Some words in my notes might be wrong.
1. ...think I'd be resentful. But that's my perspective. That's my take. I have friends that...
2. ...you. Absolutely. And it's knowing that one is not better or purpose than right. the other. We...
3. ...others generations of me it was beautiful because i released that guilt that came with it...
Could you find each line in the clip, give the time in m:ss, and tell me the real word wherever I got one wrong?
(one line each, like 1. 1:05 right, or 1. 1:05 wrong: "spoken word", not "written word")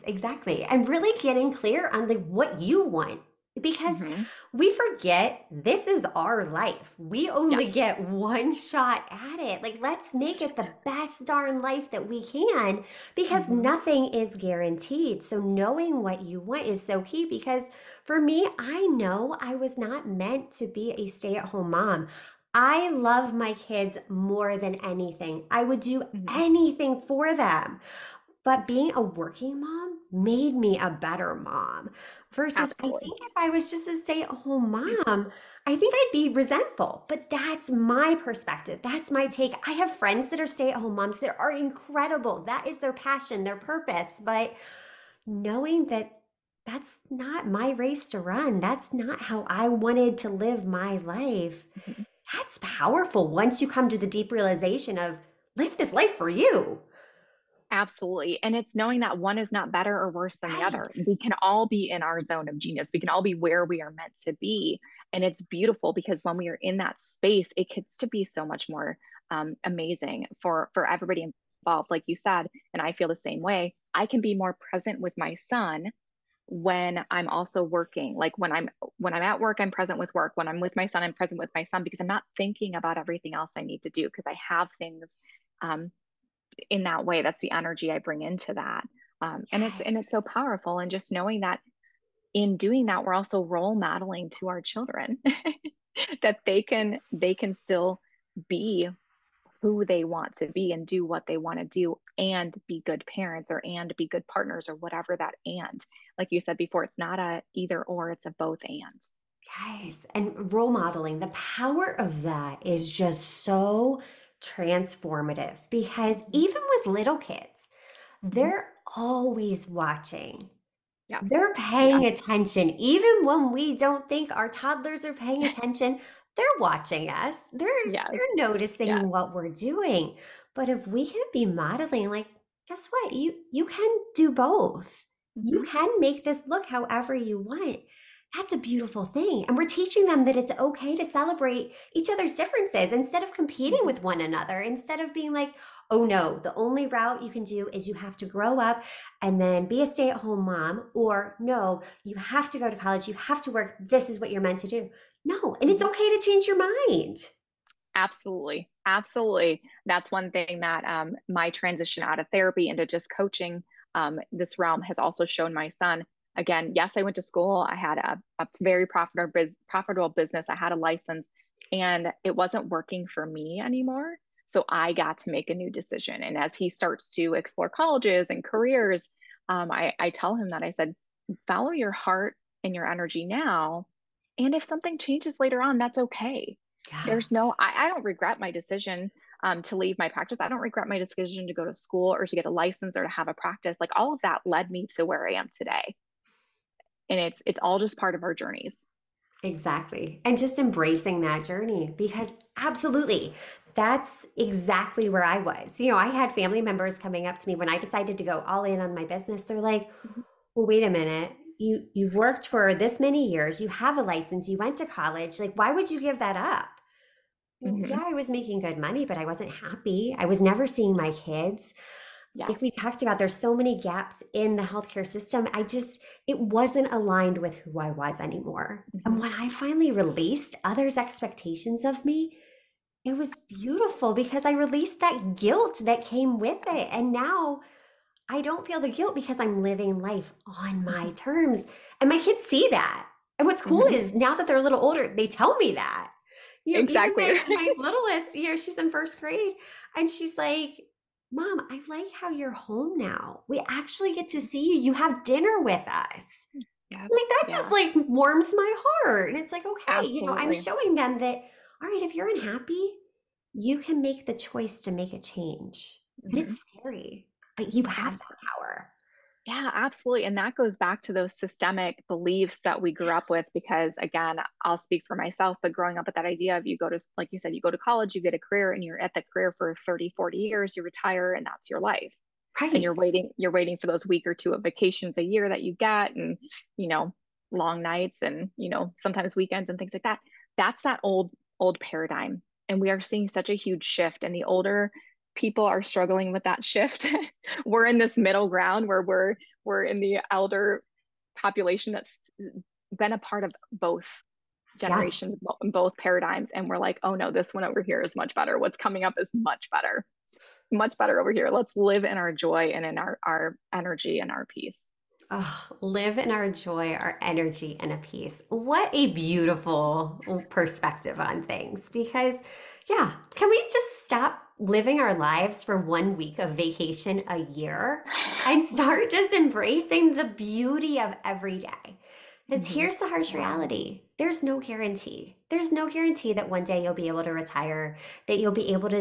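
1. 0:35 right
2. 0:56 wrong: "worse", not "purpose"
3. 3:50 wrong: "expectations", not "generations".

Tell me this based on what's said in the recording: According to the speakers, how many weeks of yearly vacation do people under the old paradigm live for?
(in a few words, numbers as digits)
1.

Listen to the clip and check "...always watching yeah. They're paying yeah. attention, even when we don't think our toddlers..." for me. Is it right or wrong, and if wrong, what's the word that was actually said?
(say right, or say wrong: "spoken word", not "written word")
right.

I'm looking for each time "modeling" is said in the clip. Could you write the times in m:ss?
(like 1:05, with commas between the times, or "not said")
1:33, 1:50, 2:11.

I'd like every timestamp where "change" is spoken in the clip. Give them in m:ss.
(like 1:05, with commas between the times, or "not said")
2:36, 3:04, 4:25.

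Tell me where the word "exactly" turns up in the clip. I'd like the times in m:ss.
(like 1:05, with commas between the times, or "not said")
0:00, 3:19, 3:24, 4:06.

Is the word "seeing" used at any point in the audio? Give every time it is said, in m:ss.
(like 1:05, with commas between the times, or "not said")
3:40, 4:53.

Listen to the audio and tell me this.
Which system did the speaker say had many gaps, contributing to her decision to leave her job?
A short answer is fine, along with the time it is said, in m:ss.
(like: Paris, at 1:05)
The healthcare system, at 3:44.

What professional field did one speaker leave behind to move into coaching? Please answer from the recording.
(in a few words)
Therapy.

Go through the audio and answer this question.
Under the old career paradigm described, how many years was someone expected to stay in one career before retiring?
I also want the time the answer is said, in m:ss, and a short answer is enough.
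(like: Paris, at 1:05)
30 to 40 years, at 4:39.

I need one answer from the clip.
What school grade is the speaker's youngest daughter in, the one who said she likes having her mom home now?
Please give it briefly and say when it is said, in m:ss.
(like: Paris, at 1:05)
First grade, at 4:08.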